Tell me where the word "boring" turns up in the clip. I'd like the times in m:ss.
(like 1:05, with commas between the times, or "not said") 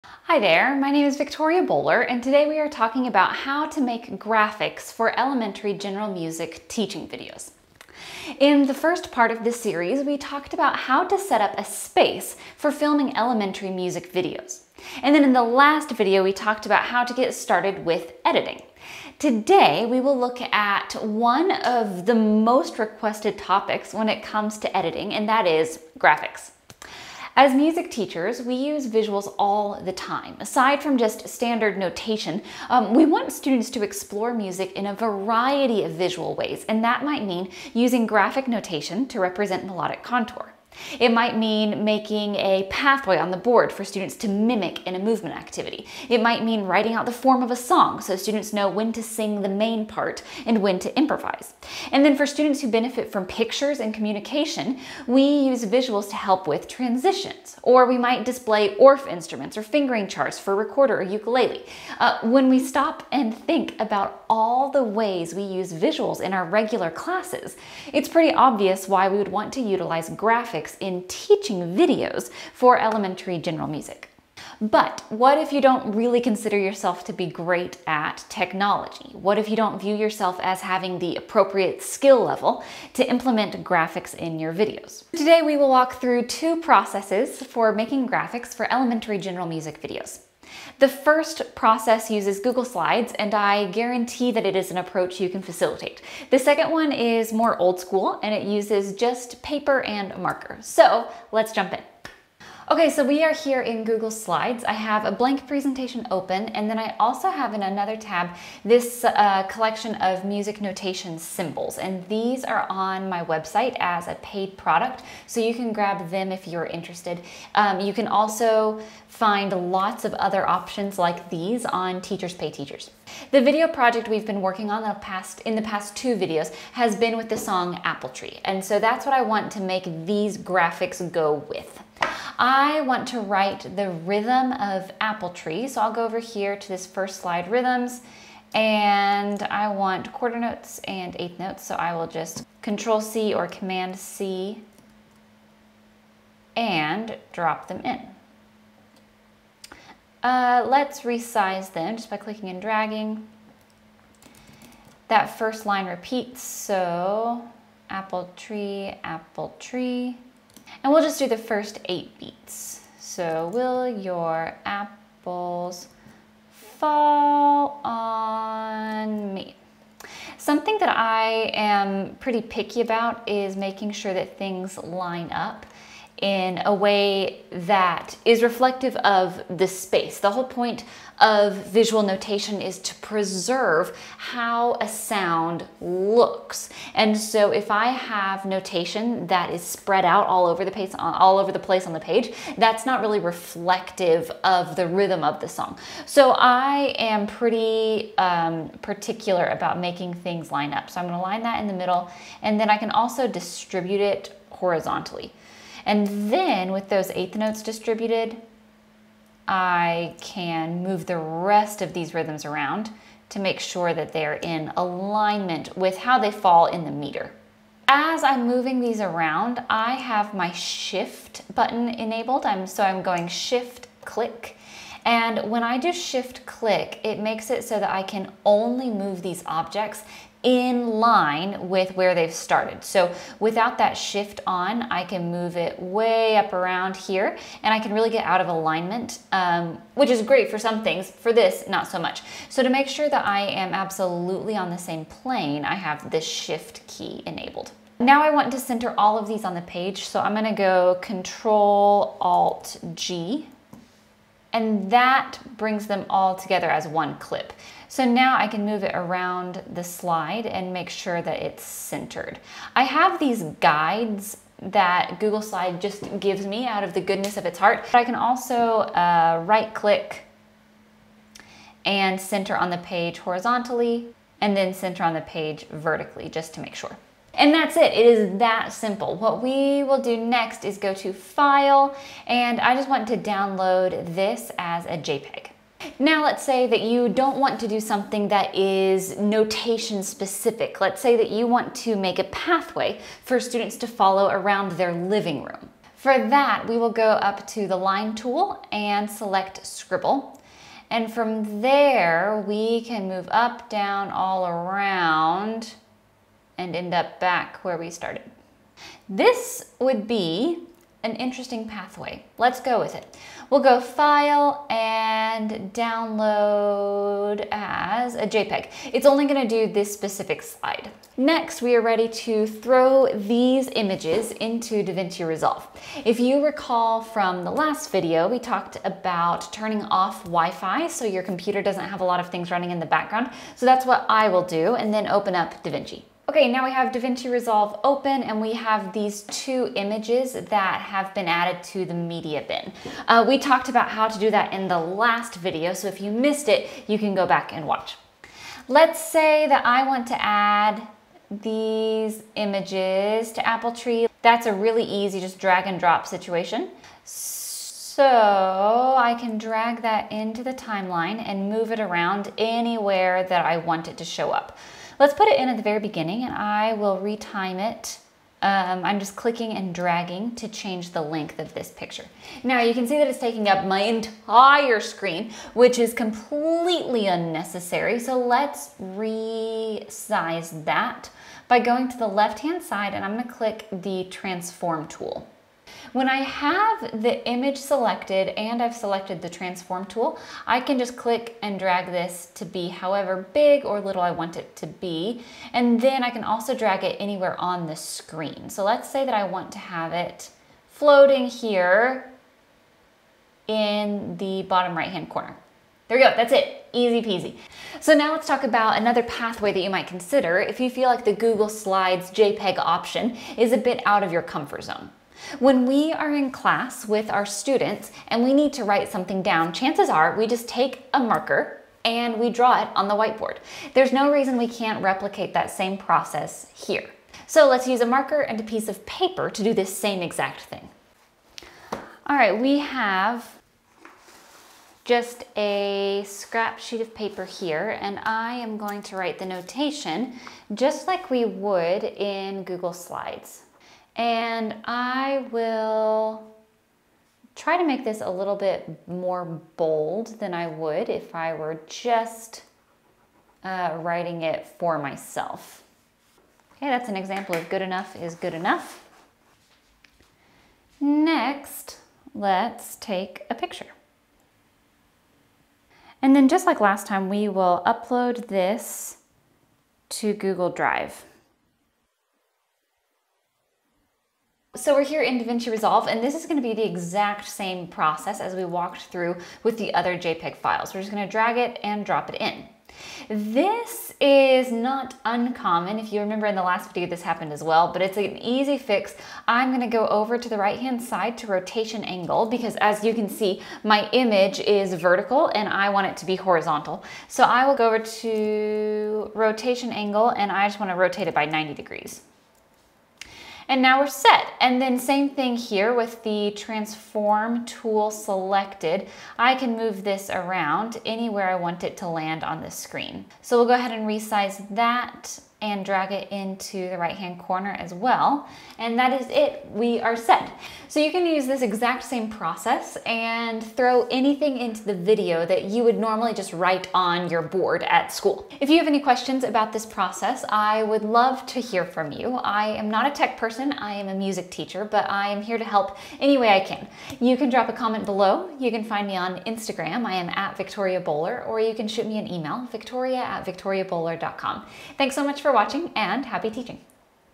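not said.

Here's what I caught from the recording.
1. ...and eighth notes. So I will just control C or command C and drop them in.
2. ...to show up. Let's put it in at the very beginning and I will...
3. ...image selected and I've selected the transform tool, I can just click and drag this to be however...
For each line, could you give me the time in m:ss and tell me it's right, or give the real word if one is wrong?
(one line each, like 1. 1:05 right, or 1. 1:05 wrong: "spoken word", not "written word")
1. 2:20 right
2. 6:03 right
3. 6:27 right.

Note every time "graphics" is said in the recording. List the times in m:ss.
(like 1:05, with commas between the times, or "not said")
0:04, 0:25, 0:38, 1:10, 1:23, 1:28, 2:10.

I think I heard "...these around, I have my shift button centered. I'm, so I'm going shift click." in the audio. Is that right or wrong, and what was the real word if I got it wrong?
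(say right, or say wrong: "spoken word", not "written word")
wrong: "enabled", not "centered".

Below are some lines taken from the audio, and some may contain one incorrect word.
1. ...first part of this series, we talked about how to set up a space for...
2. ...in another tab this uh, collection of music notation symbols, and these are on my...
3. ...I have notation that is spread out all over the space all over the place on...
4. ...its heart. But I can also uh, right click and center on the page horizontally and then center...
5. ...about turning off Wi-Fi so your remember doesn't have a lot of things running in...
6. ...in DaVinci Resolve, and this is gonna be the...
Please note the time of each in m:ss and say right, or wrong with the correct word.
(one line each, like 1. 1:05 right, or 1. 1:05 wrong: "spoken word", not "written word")
1. 0:08 right
2. 1:47 right
3. 3:07 wrong: "place", not "space"
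4. 4:27 right
5. 5:28 wrong: "computer", not "remember"
6. 7:55 right.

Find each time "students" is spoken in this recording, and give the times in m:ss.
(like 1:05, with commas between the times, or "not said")
0:33, 0:43, 0:48, 0:52, 4:53, 6:57.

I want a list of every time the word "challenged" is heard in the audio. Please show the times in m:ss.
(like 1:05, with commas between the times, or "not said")
not said.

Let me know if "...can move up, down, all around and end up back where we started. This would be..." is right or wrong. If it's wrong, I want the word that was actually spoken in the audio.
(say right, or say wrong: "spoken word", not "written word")
right.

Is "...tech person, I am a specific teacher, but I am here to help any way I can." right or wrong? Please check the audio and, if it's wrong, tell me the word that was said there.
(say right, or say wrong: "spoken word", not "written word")
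wrong: "music", not "specific".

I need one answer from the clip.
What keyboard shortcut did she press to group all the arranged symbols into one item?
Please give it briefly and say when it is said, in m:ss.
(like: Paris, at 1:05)
Control Alt G, at 4:11.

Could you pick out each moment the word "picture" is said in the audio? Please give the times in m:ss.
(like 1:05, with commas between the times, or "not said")
0:53, 6:11, 7:43.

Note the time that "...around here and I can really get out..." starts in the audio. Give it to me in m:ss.
3:56.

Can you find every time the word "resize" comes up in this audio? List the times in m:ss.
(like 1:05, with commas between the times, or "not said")
2:31, 6:18, 8:33.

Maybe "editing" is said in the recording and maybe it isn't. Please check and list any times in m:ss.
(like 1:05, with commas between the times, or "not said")
0:18, 0:24.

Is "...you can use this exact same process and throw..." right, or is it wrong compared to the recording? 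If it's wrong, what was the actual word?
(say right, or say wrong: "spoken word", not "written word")
right.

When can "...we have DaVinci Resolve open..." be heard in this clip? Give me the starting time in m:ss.
5:36.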